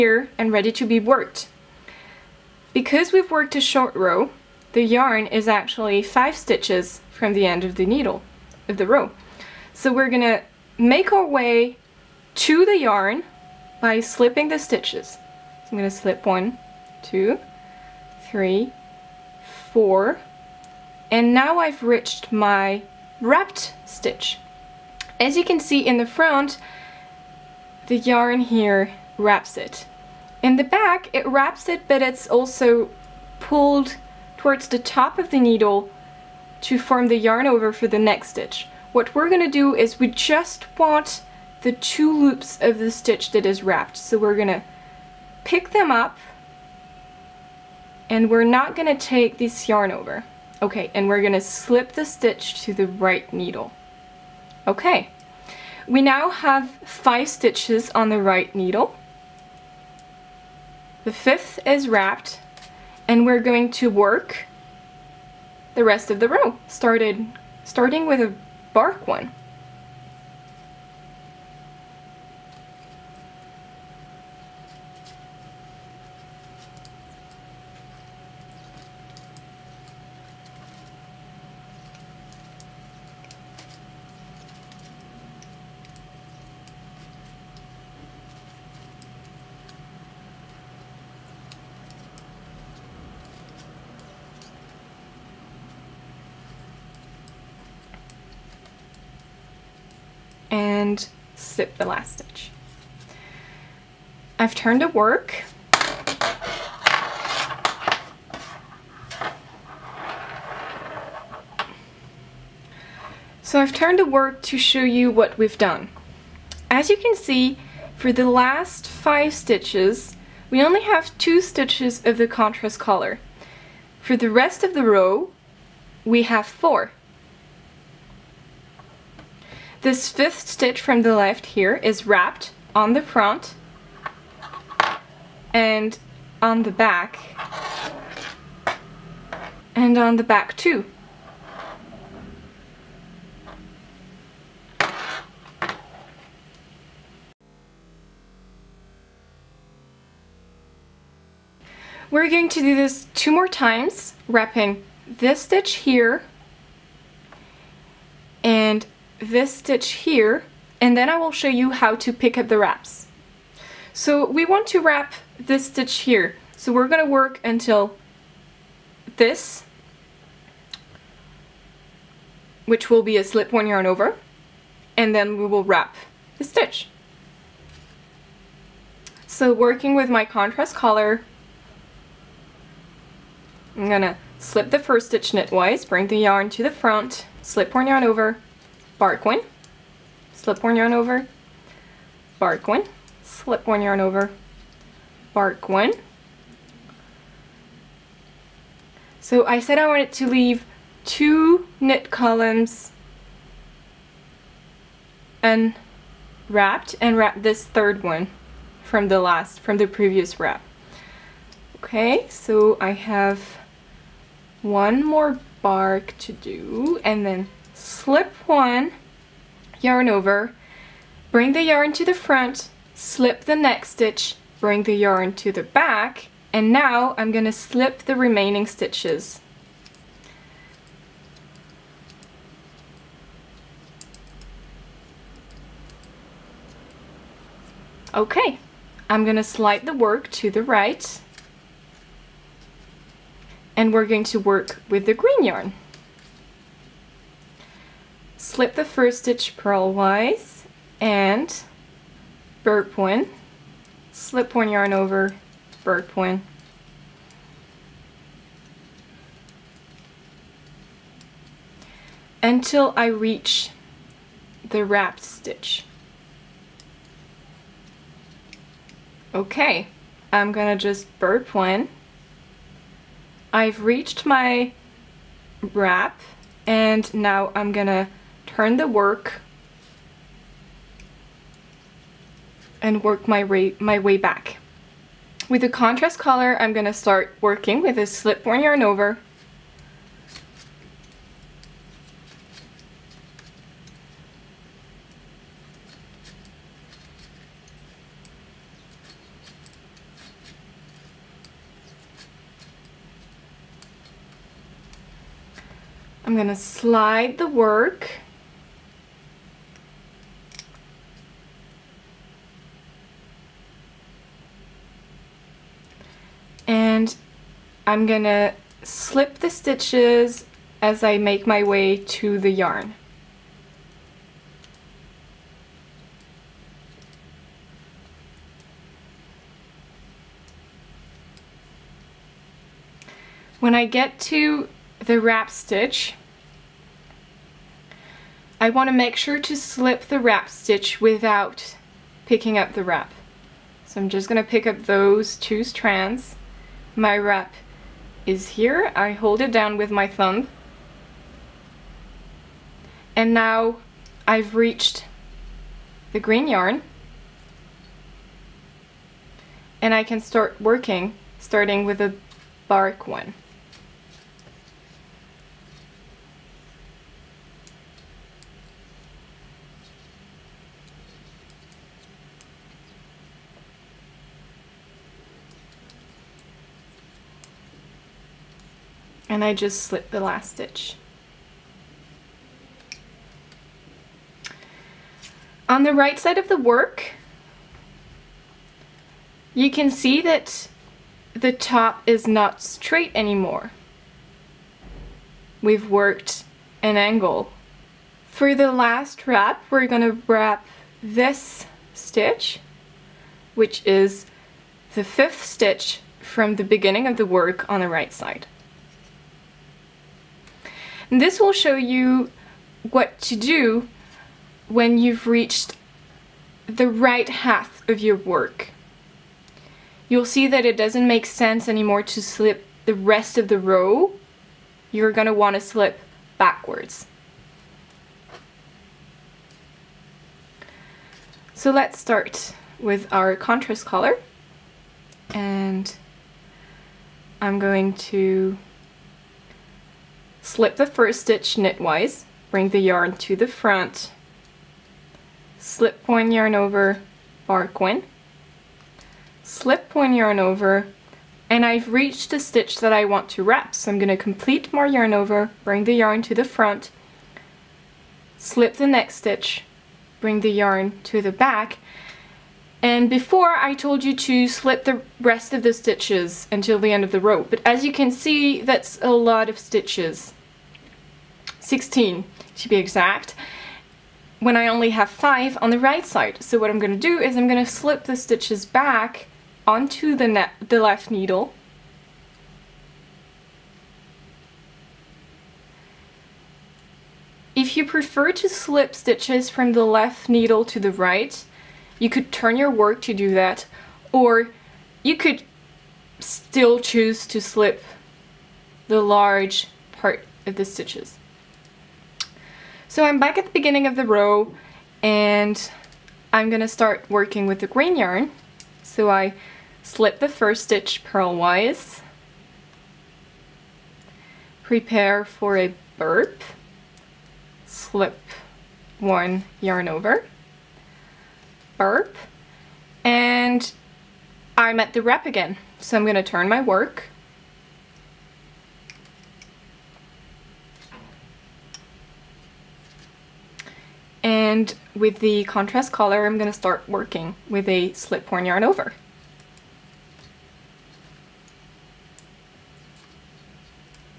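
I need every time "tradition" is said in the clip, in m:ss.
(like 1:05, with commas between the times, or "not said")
not said.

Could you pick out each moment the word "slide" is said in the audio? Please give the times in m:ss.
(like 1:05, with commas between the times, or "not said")
3:59, 5:06.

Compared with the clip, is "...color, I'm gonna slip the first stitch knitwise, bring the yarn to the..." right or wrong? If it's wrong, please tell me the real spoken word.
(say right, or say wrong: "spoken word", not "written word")
right.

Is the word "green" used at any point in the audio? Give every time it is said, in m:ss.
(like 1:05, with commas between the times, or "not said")
4:05, 5:56, 8:27.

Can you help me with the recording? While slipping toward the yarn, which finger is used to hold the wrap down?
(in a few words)
thumb.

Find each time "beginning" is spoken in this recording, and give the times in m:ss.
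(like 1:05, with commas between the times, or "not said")
6:46, 8:23.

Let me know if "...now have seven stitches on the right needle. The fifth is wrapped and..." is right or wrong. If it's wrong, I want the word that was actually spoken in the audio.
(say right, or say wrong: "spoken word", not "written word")
wrong: "five", not "seven".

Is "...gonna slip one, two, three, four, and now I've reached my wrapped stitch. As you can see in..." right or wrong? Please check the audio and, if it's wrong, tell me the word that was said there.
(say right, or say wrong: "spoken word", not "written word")
right.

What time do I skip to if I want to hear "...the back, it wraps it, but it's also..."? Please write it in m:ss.
0:30.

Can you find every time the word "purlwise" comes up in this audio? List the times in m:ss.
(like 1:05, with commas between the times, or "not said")
4:09, 8:31.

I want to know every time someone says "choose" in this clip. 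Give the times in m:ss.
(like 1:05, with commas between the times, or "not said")
8:16.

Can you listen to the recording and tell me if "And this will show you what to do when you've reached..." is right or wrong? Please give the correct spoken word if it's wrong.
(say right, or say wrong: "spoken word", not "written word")
right.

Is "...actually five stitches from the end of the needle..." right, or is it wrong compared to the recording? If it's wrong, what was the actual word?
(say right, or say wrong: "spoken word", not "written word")
right.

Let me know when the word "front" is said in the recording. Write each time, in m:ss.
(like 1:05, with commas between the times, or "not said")
0:26, 2:13, 3:06, 3:42, 7:23, 7:36.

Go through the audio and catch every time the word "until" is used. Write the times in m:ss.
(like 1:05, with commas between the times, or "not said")
2:47, 4:22, 7:46.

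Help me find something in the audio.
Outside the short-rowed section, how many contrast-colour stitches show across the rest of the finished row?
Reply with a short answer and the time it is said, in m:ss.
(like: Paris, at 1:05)
4, at 2:04.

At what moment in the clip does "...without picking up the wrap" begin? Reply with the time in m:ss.
5:40.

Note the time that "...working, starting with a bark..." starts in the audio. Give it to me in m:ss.
6:00.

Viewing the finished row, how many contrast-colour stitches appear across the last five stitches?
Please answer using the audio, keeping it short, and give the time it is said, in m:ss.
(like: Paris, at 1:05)
2, at 2:00.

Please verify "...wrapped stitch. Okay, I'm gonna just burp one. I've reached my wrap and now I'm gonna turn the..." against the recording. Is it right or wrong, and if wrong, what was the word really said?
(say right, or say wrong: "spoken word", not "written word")
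right.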